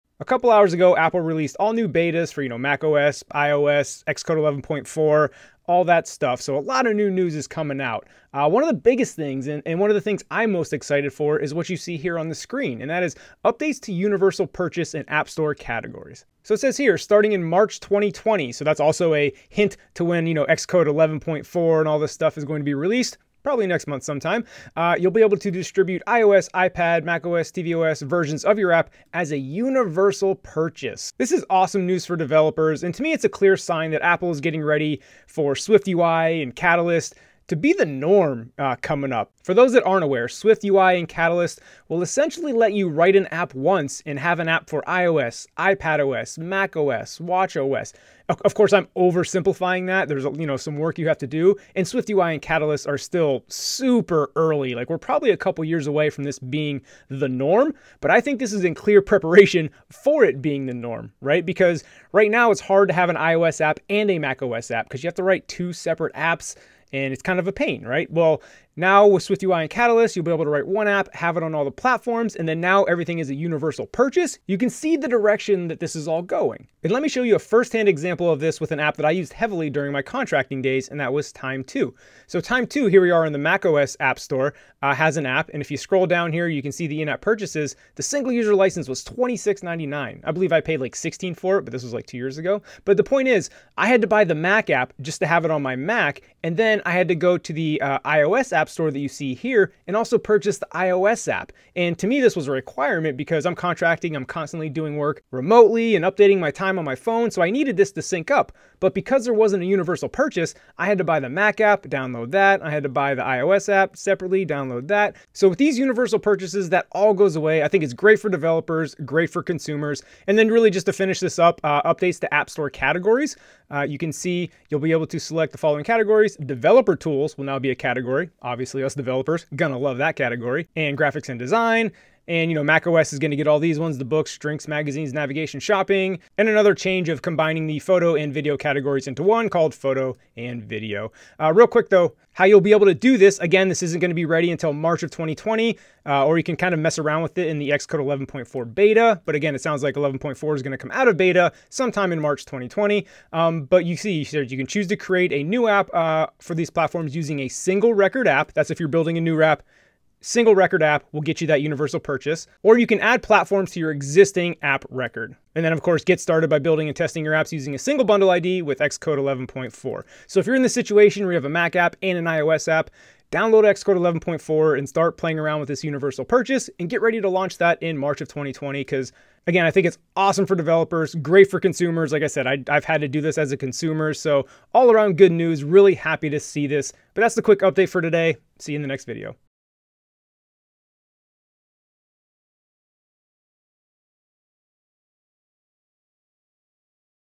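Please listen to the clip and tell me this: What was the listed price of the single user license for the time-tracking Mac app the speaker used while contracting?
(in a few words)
$26.99.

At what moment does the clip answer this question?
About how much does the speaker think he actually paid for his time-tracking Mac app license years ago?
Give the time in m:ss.
1:30.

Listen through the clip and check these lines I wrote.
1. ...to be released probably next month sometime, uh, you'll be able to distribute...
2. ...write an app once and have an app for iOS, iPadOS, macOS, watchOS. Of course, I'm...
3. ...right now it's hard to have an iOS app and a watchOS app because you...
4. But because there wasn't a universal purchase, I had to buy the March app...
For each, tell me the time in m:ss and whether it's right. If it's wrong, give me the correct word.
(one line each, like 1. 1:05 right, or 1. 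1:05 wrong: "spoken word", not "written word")
1. 0:22 right
2. 0:42 right
3. 1:02 wrong: "macOS", not "watchOS"
4. 1:48 wrong: "Mac", not "March".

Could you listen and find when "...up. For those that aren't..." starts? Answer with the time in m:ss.
0:39.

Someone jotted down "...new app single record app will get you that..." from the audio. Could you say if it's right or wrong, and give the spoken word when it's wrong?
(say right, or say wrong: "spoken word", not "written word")
right.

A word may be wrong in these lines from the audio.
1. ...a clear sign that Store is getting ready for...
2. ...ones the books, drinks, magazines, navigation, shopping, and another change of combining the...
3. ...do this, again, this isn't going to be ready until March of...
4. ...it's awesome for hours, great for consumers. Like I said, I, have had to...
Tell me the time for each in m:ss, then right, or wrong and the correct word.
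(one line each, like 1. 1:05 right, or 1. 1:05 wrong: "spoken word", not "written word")
1. 0:33 wrong: "Apple", not "Store"
2. 2:13 right
3. 2:22 right
4. 2:59 wrong: "developers", not "hours".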